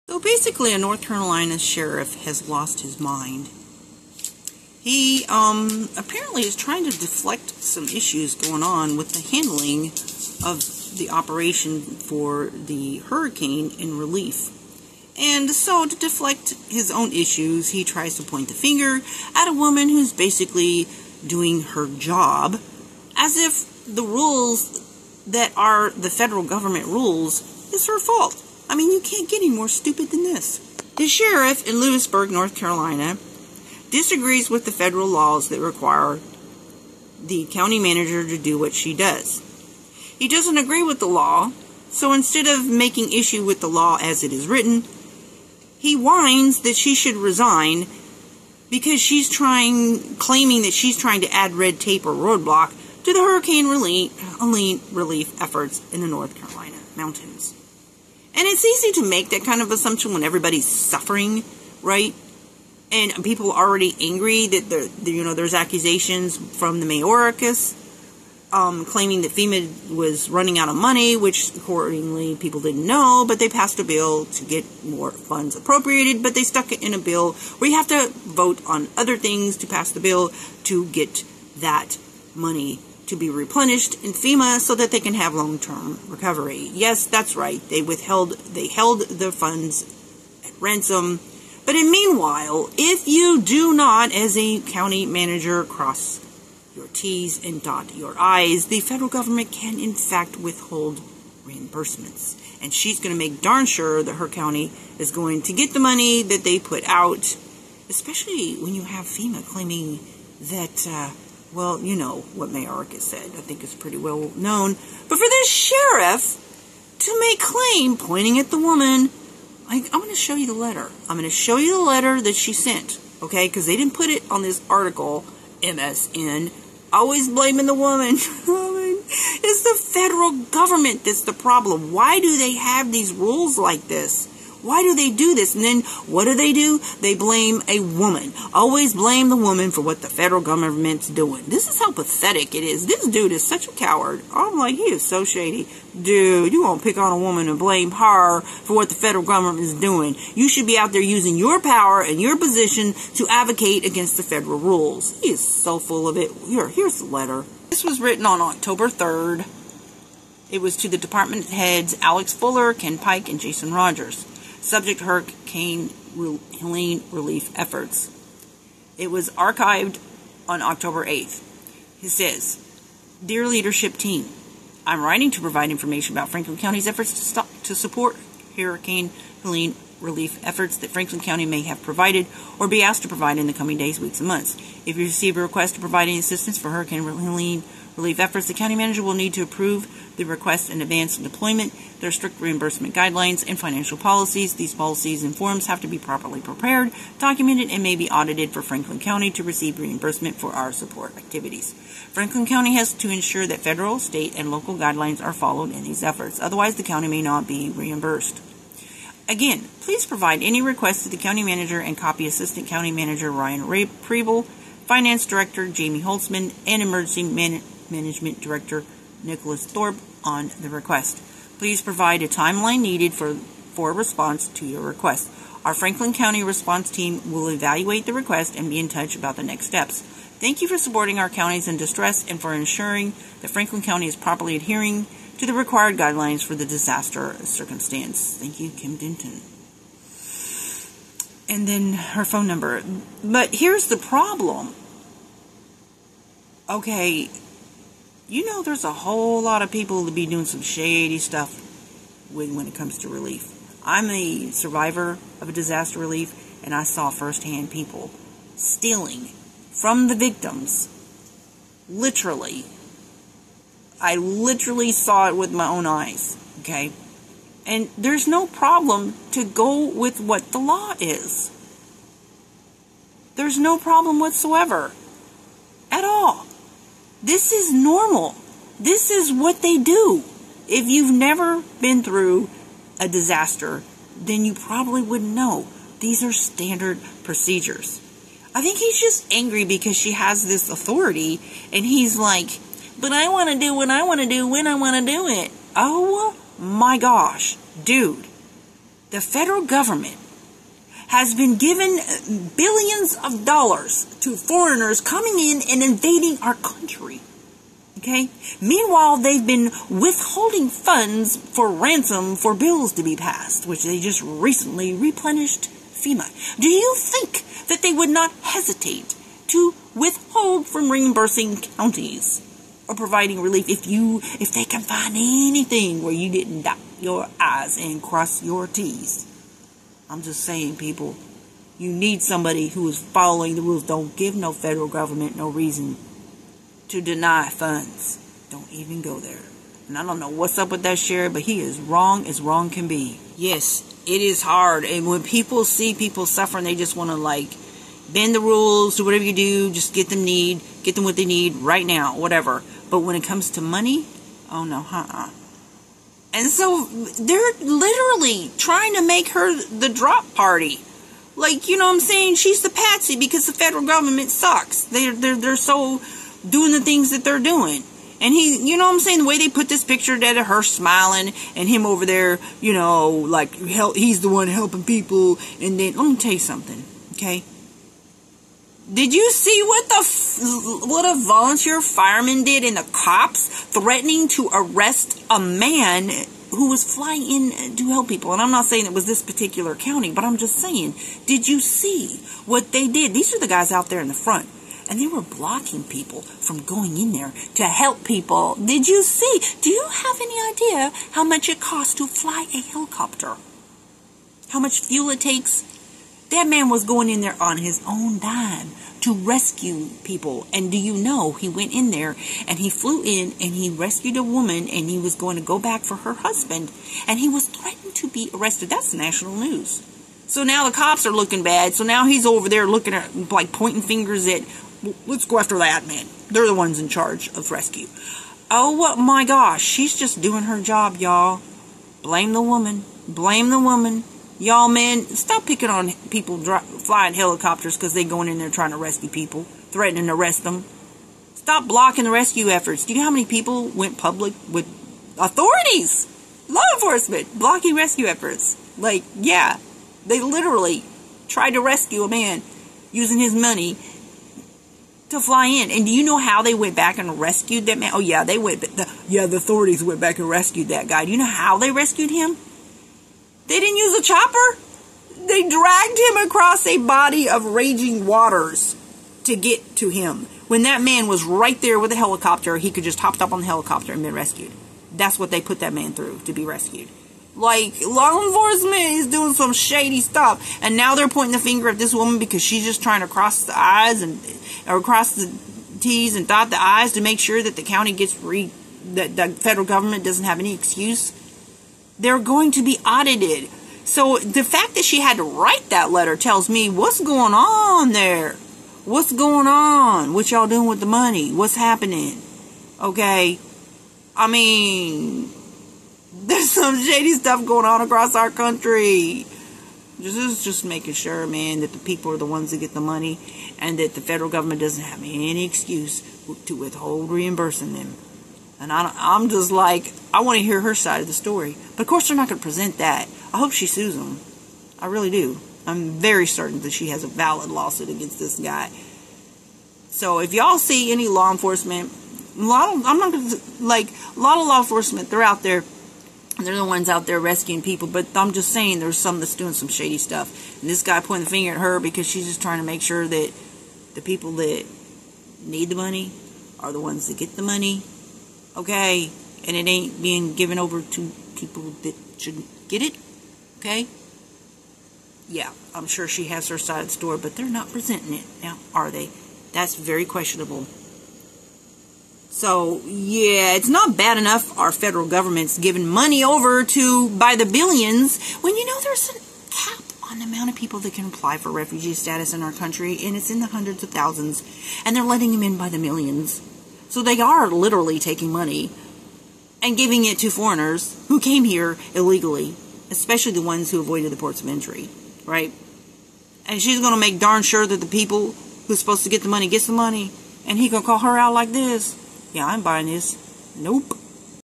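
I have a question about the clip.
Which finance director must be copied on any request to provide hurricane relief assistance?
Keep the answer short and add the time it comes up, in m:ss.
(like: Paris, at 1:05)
Jamie Holtzman, at 3:35.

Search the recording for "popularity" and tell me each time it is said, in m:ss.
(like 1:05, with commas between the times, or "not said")
not said.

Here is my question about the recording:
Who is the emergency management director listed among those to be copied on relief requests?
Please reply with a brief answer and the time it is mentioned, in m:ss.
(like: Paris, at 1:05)
Nicholas Thorpe, at 3:39.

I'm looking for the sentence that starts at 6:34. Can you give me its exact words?
And they were blocking people from going in there to help people.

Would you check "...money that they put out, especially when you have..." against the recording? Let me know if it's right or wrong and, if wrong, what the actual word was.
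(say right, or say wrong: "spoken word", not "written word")
right.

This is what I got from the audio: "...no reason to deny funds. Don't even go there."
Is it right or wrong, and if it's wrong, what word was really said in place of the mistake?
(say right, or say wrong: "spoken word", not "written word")
right.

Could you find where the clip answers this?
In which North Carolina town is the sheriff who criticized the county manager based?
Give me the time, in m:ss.
0:31.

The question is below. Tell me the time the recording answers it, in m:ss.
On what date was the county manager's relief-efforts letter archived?
2:50.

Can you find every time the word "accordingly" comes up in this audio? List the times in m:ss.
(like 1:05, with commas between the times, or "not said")
1:11.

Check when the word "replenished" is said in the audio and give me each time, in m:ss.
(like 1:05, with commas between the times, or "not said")
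1:23, 5:14.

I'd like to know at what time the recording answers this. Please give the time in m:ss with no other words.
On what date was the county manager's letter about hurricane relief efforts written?
2:38.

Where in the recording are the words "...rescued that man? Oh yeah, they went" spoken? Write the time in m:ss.
7:37.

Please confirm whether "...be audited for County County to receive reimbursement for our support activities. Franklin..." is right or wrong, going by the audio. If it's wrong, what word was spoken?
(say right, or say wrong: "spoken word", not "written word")
wrong: "Franklin", not "County".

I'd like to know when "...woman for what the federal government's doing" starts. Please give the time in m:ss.
2:19.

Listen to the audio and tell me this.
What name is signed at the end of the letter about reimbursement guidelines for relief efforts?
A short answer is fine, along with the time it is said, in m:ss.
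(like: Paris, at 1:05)
Kim Denton, at 3:58.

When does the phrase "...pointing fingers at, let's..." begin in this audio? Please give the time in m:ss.
7:03.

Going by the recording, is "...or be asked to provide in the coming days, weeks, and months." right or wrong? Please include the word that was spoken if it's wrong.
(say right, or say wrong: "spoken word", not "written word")
right.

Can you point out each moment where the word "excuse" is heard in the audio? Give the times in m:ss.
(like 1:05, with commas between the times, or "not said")
8:10, 8:35.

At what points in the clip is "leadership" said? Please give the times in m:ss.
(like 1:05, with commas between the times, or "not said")
2:53.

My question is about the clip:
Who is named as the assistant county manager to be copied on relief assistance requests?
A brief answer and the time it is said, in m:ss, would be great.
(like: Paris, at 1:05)
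Ryan Preble, at 3:33.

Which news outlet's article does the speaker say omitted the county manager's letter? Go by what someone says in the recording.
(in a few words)
MSN.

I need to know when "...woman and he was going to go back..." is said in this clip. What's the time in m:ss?
6:54.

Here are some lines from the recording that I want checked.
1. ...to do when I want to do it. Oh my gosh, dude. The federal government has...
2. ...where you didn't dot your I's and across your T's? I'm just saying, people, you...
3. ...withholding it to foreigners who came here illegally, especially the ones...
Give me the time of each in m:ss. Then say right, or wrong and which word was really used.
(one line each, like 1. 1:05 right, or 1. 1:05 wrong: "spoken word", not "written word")
1. 4:54 right
2. 5:26 wrong: "cross", not "across"
3. 9:39 wrong: "giving", not "withholding".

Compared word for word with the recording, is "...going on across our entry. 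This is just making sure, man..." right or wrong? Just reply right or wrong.
wrong.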